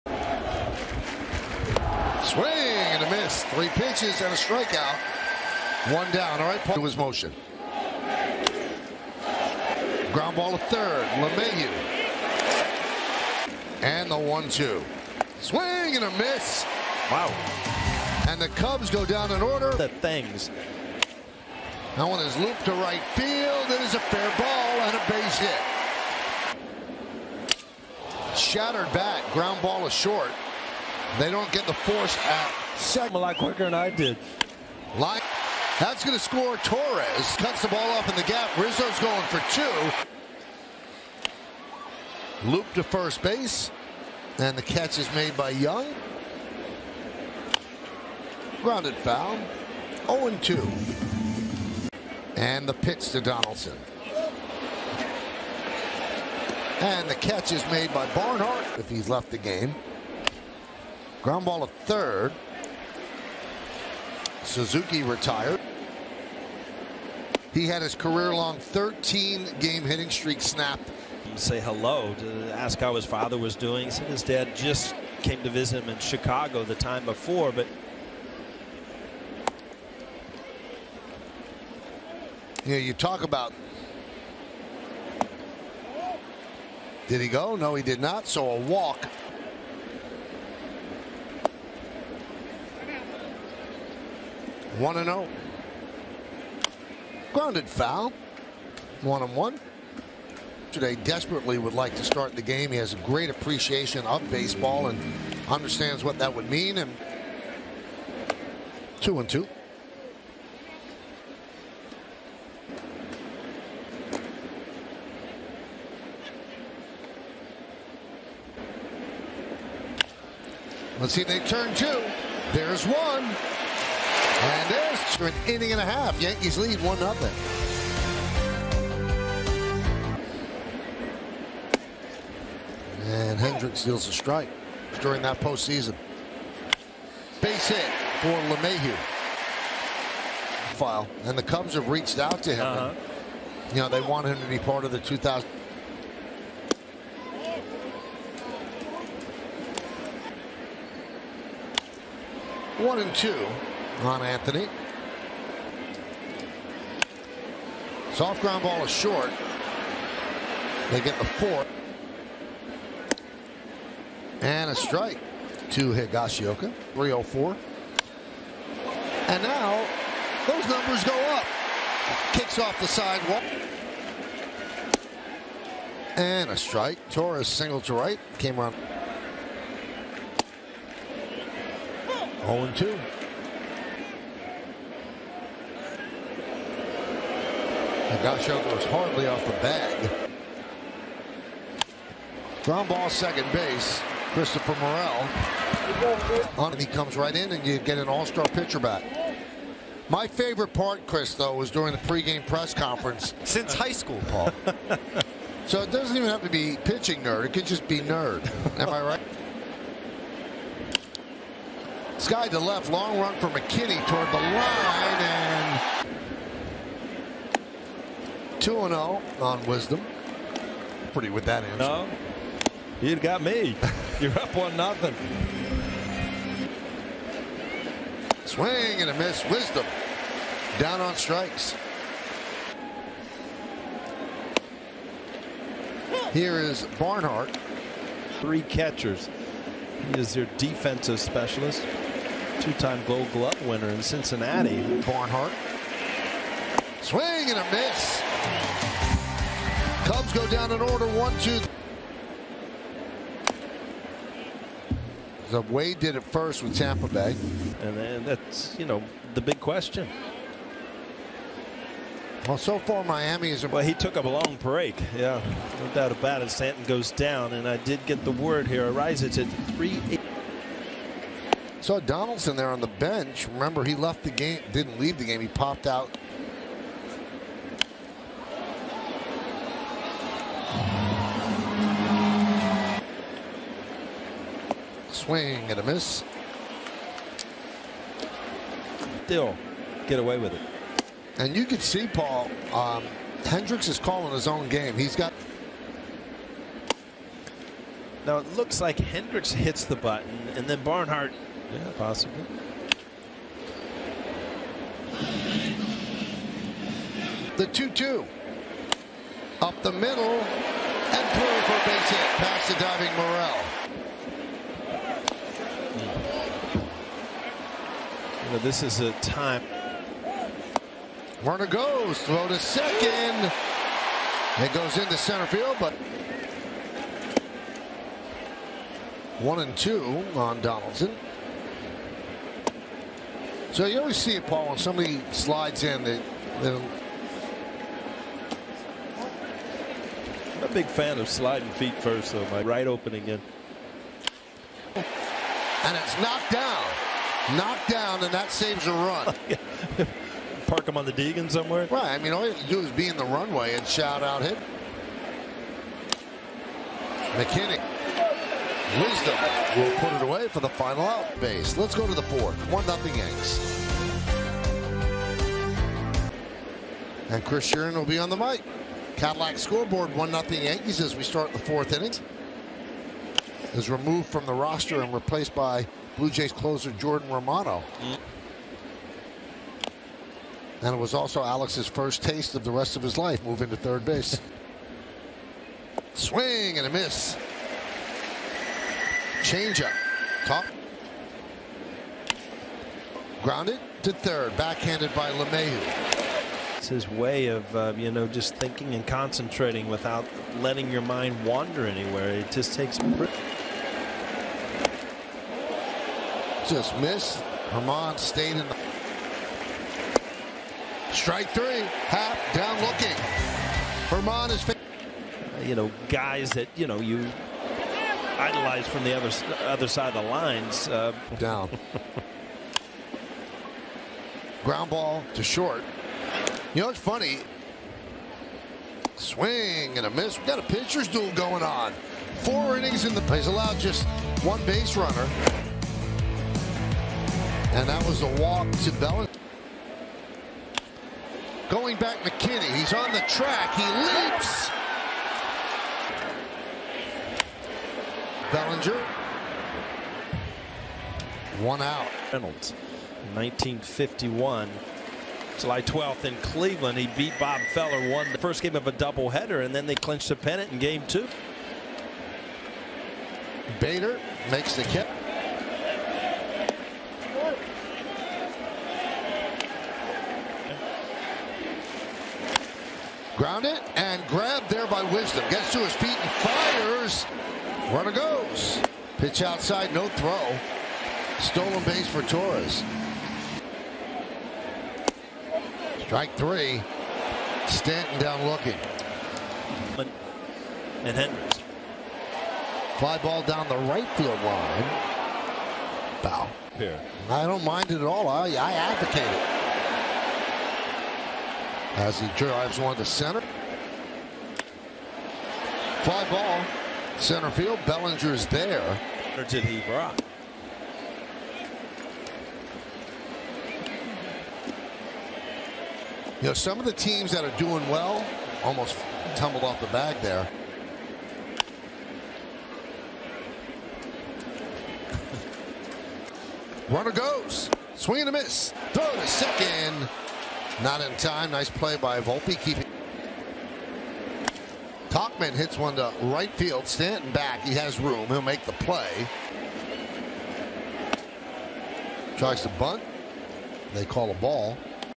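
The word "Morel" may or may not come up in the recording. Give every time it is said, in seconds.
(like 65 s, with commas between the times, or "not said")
194 s, 313 s.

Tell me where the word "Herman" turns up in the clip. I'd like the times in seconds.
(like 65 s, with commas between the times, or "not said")
407 s, 414 s.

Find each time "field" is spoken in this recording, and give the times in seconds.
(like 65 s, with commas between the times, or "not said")
23 s, 325 s, 494 s, 507 s, 536 s.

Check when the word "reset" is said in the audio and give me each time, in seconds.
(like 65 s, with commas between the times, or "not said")
not said.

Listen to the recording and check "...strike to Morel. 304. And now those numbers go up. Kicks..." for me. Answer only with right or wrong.
wrong.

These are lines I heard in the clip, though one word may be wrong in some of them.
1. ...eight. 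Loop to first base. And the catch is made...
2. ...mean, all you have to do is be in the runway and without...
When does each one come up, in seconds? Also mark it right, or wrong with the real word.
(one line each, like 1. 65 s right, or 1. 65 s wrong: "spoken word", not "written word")
1. 39 s wrong: "two", not "eight"
2. 352 s wrong: "shout", not "without".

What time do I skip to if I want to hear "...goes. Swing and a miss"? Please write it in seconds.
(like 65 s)
527 s.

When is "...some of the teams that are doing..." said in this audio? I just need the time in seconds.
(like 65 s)
516 s.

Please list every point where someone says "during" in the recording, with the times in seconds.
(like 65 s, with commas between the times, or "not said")
135 s, 201 s.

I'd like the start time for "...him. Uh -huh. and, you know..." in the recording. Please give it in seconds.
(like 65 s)
142 s.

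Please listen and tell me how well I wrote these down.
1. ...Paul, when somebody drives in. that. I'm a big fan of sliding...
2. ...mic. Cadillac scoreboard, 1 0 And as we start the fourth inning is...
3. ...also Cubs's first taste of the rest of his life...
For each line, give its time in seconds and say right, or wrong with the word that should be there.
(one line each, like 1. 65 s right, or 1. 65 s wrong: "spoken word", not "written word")
1. 334 s wrong: "slides", not "drives"
2. 368 s wrong: "Yankees", not "And"
3. 381 s wrong: "Alex", not "Cubs".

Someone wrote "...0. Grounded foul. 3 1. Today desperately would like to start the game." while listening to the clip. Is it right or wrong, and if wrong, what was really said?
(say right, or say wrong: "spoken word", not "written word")
wrong: "1", not "3".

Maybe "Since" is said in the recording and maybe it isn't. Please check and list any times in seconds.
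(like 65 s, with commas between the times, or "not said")
203 s.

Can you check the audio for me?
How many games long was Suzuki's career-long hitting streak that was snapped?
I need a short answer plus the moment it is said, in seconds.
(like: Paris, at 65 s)
13, at 68 s.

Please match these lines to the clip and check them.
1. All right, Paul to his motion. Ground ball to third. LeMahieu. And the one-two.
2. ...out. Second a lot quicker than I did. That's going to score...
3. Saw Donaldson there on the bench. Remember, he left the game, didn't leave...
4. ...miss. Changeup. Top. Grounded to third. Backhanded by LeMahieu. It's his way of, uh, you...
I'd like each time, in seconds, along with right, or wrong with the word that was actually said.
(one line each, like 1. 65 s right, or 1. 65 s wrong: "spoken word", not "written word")
1. 6 s right
2. 32 s right
3. 271 s right
4. 386 s right.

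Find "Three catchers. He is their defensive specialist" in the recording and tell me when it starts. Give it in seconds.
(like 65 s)
238 s.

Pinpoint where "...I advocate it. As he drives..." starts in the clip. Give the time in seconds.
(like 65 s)
498 s.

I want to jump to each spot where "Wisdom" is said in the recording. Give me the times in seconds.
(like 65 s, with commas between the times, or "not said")
219 s, 229 s, 358 s, 475 s.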